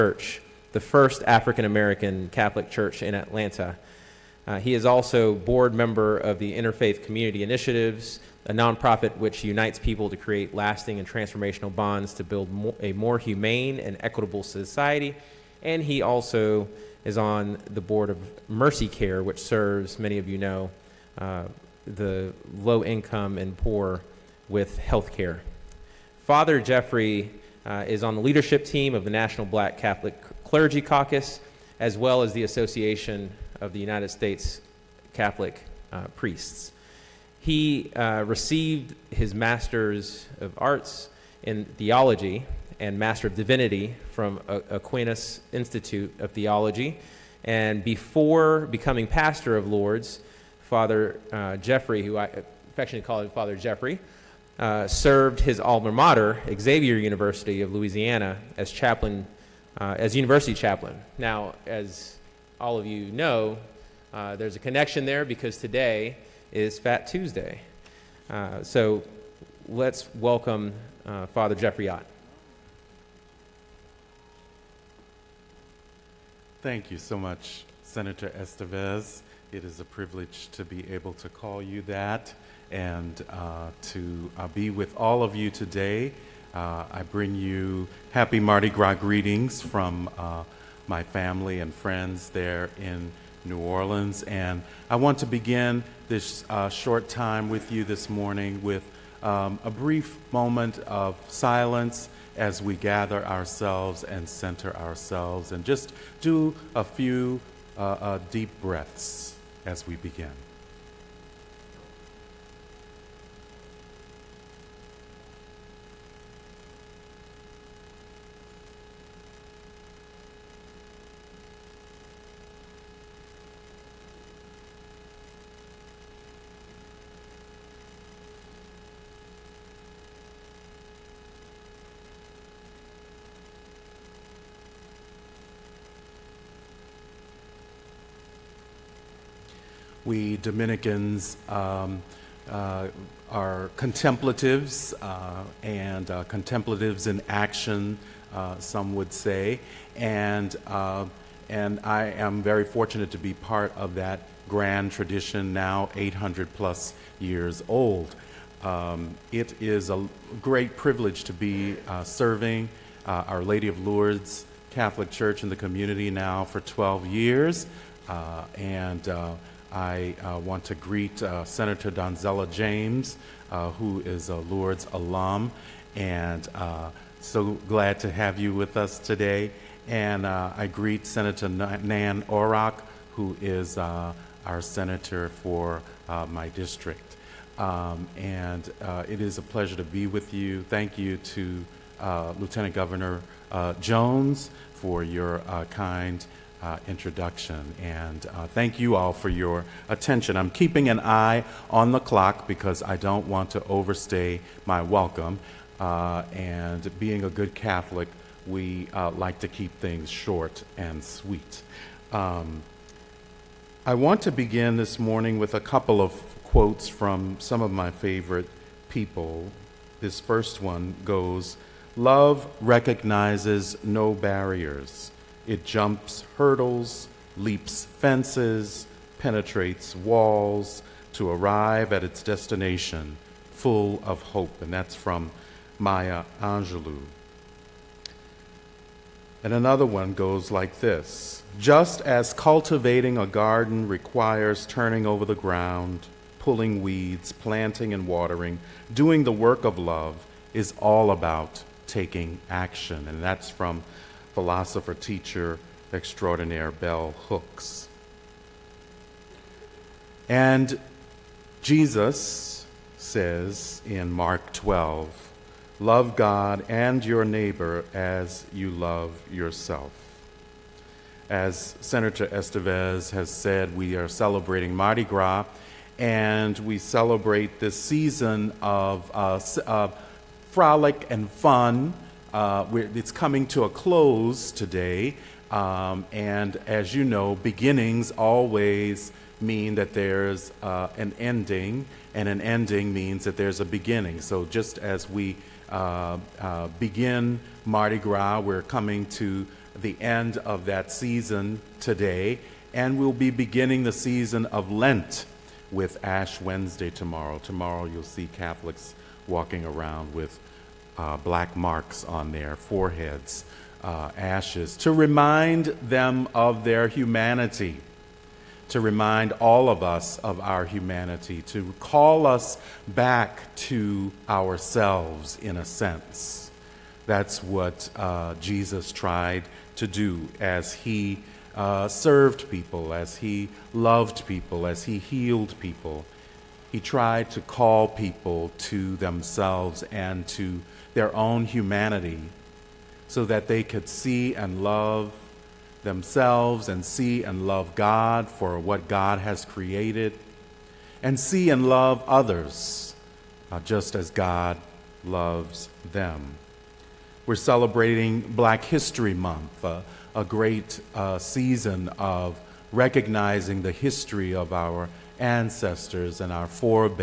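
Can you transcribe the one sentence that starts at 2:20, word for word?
We Dominicans um, uh, are contemplatives uh, and uh, contemplatives in action, uh, some would say.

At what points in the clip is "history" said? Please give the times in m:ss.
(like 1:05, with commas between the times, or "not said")
5:58, 6:03.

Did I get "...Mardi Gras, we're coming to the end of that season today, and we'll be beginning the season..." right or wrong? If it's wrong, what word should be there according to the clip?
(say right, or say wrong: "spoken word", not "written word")
right.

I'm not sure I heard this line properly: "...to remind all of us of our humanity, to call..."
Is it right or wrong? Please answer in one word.
right.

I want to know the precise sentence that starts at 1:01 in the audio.
Now, as all of you know, uh, there's a connection there because today is Fat Tuesday.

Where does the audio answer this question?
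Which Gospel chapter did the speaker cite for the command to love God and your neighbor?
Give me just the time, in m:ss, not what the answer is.
4:24.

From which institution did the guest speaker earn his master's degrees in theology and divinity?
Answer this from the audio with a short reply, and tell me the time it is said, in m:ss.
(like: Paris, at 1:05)
Aquinas Institute of Theology, at 0:44.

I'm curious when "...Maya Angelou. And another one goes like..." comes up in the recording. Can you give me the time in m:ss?
3:55.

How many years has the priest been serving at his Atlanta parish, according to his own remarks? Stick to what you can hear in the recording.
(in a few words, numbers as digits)
12.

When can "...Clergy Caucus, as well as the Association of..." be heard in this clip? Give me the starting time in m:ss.
0:30.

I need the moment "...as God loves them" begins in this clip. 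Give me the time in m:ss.
5:53.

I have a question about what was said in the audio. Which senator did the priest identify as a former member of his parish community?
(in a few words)
Donzella James.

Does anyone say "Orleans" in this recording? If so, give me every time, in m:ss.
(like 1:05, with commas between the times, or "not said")
1:33.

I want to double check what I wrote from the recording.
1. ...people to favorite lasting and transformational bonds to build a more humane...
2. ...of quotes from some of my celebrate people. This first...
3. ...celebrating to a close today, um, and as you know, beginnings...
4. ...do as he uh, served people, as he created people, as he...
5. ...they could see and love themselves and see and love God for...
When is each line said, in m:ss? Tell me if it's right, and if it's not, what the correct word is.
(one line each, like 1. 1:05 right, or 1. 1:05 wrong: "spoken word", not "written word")
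1. 0:09 wrong: "create", not "favorite"
2. 3:36 wrong: "favorite", not "celebrate"
3. 4:43 wrong: "coming", not "celebrating"
4. 5:29 wrong: "loved", not "created"
5. 5:43 right.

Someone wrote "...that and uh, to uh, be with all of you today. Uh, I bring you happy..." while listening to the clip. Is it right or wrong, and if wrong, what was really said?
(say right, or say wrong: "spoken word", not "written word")
right.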